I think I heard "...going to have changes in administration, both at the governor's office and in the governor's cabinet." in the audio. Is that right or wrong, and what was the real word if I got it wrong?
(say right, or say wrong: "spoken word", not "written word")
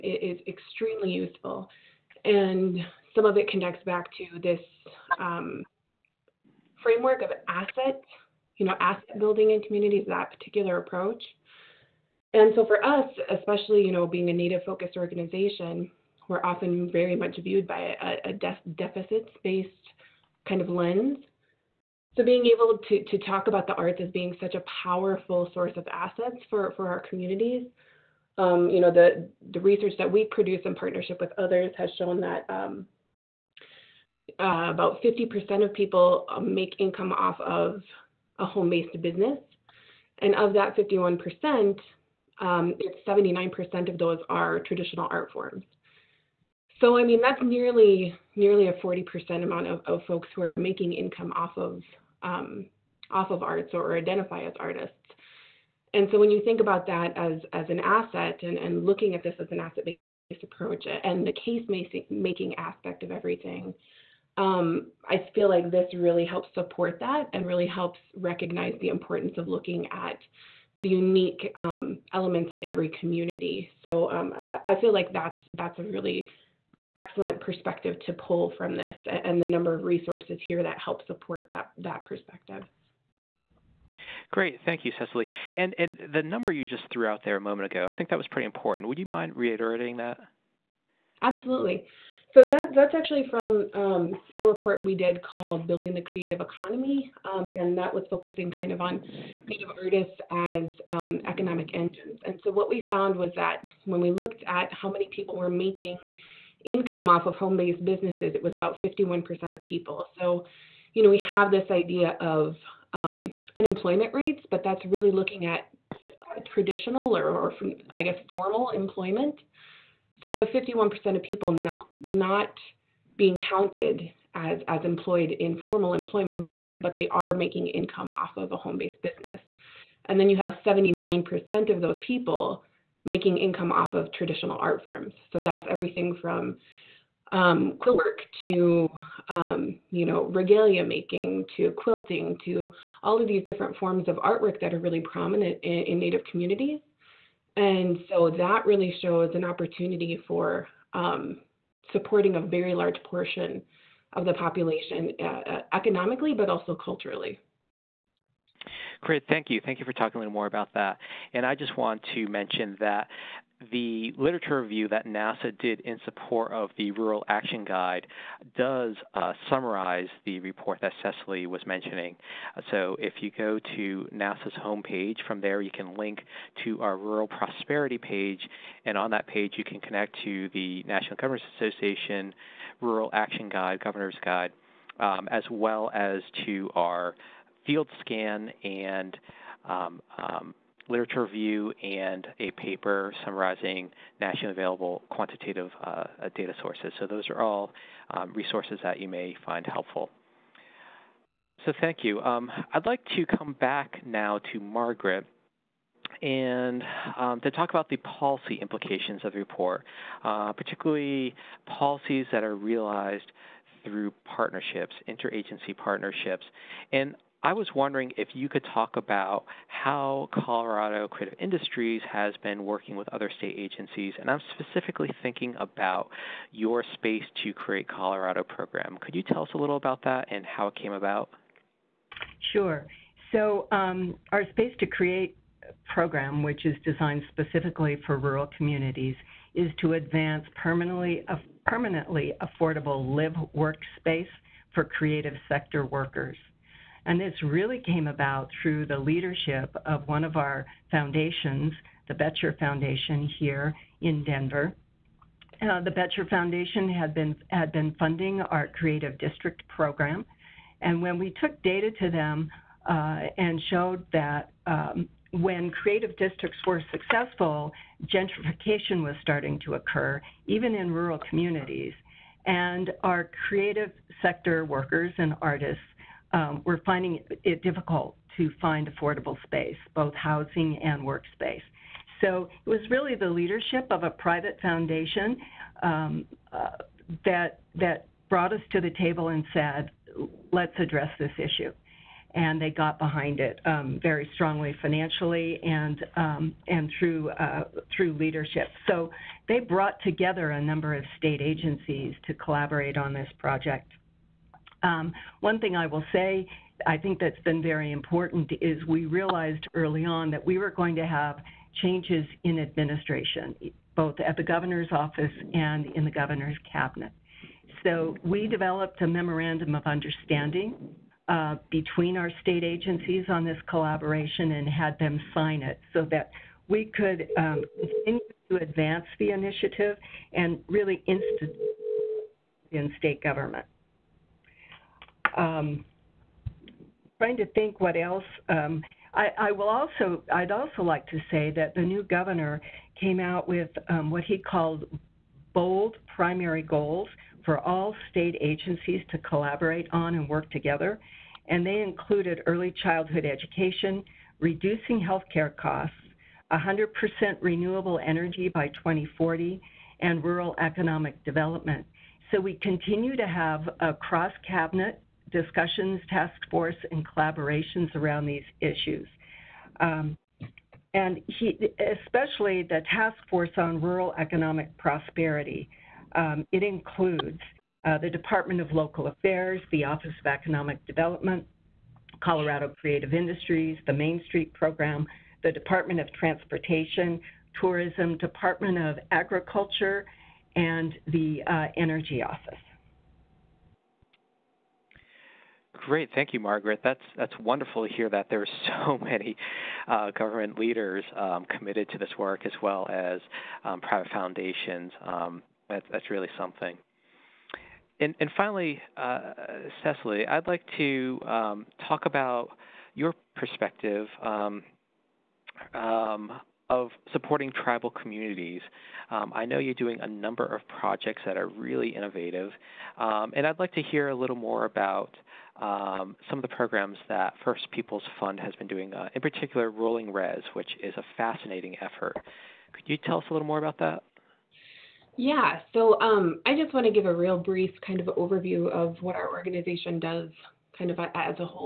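right.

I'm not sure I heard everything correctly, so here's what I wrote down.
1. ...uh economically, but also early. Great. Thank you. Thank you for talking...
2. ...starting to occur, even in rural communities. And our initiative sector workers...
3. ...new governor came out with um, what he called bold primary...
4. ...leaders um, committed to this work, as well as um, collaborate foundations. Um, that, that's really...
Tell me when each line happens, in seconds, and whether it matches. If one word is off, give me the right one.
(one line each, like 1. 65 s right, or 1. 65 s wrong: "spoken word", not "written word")
1. 155 s wrong: "culturally", not "early"
2. 269 s wrong: "creative", not "initiative"
3. 341 s right
4. 400 s wrong: "private", not "collaborate".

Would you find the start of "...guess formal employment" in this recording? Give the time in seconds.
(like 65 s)
118 s.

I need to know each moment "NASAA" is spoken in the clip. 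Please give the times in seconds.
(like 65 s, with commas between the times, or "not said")
165 s, 174 s.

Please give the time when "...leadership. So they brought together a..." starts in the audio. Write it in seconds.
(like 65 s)
298 s.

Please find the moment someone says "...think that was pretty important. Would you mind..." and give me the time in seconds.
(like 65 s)
87 s.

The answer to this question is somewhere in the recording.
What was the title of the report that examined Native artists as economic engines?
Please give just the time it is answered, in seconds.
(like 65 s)
95 s.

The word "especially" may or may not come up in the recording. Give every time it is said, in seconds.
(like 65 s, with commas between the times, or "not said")
13 s, 372 s.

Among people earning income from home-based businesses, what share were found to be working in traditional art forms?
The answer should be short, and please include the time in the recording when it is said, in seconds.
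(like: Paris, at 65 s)
79%, at 43 s.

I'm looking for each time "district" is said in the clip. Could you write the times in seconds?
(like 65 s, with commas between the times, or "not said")
259 s, 266 s.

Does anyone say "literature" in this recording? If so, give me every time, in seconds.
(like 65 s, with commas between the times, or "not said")
164 s, 190 s.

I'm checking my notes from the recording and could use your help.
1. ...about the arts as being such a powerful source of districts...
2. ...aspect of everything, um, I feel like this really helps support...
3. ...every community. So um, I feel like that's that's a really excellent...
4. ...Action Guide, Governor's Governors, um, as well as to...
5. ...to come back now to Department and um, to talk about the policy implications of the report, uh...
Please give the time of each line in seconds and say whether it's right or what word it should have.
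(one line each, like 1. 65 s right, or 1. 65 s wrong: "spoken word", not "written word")
1. 23 s wrong: "assets", not "districts"
2. 62 s right
3. 72 s right
4. 183 s wrong: "Guide", not "Governors"
5. 203 s wrong: "Margaret", not "Department".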